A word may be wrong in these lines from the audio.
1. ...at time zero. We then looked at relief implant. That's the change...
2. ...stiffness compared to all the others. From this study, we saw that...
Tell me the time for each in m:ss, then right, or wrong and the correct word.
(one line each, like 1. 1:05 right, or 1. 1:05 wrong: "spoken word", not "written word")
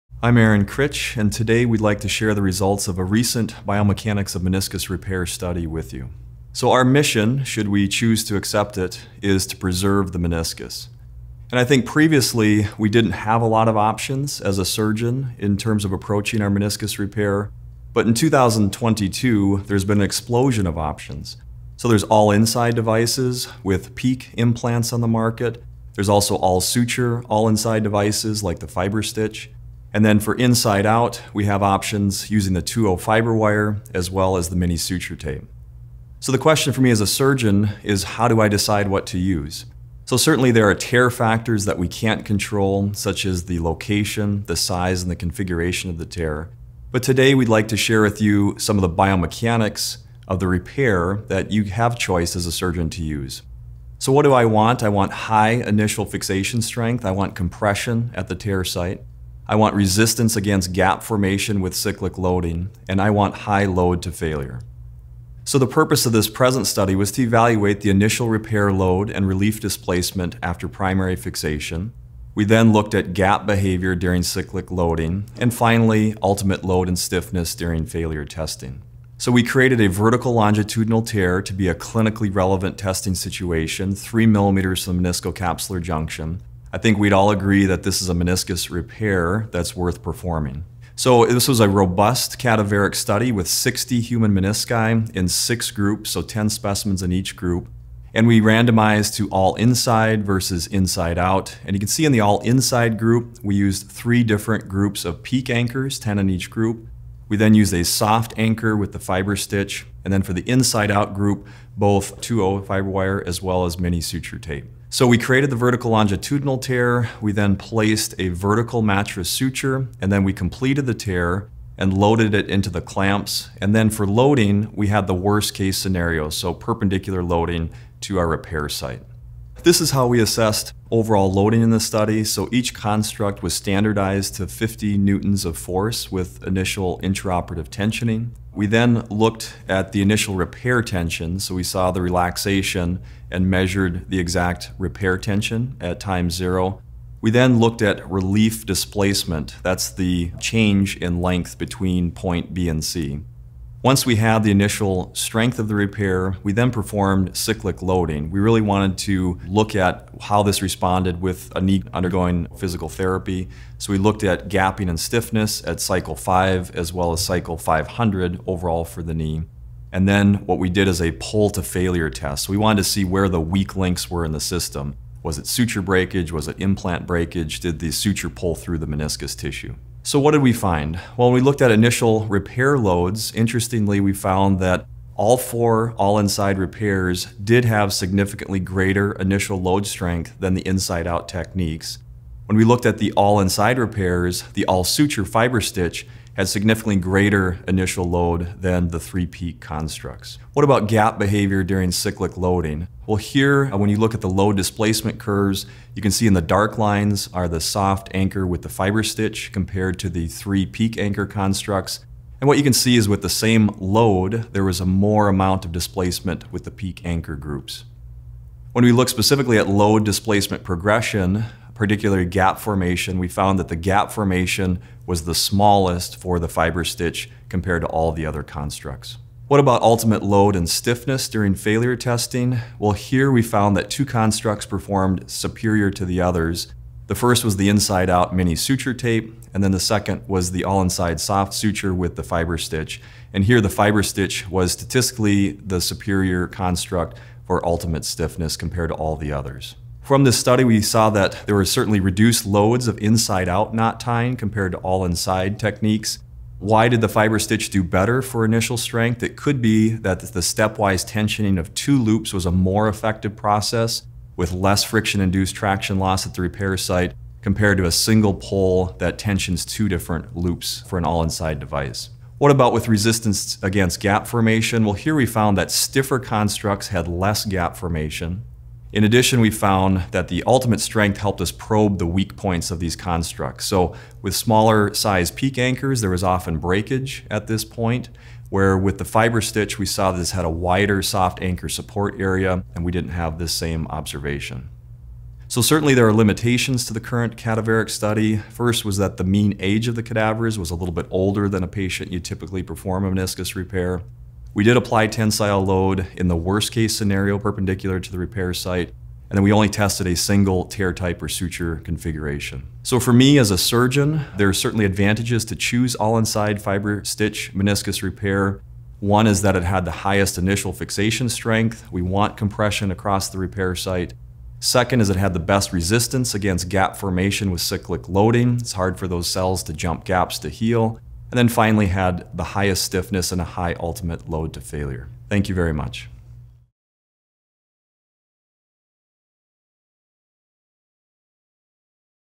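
1. 2:25 wrong: "displacement", not "implant"
2. 4:08 right.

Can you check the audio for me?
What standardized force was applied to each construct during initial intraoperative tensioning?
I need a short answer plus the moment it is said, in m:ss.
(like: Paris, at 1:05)
50 newtons, at 2:14.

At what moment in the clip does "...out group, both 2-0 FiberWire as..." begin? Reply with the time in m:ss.
1:50.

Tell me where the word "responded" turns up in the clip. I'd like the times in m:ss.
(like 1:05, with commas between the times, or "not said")
2:40.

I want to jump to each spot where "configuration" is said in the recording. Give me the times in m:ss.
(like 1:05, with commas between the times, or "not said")
0:45, 5:11.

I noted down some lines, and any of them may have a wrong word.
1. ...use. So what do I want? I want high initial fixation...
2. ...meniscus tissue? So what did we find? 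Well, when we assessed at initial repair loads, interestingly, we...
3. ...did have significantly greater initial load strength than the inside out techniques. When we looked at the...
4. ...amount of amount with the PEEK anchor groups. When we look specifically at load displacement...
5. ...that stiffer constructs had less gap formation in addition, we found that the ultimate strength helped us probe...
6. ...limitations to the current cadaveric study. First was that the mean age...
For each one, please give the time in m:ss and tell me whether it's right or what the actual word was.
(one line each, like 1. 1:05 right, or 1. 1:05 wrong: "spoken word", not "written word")
1. 0:53 right
2. 2:58 wrong: "looked", not "assessed"
3. 3:07 right
4. 3:35 wrong: "displacement", not "amount"
5. 4:35 right
6. 4:56 right.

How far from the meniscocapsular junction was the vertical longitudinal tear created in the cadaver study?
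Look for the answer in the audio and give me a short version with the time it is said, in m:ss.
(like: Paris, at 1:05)
3 millimeters, at 1:23.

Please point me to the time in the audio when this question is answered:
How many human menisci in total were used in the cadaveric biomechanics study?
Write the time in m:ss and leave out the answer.
1:33.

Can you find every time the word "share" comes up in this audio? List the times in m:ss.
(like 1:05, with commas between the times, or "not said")
0:02, 0:47.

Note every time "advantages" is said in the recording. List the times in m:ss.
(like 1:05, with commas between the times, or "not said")
5:14.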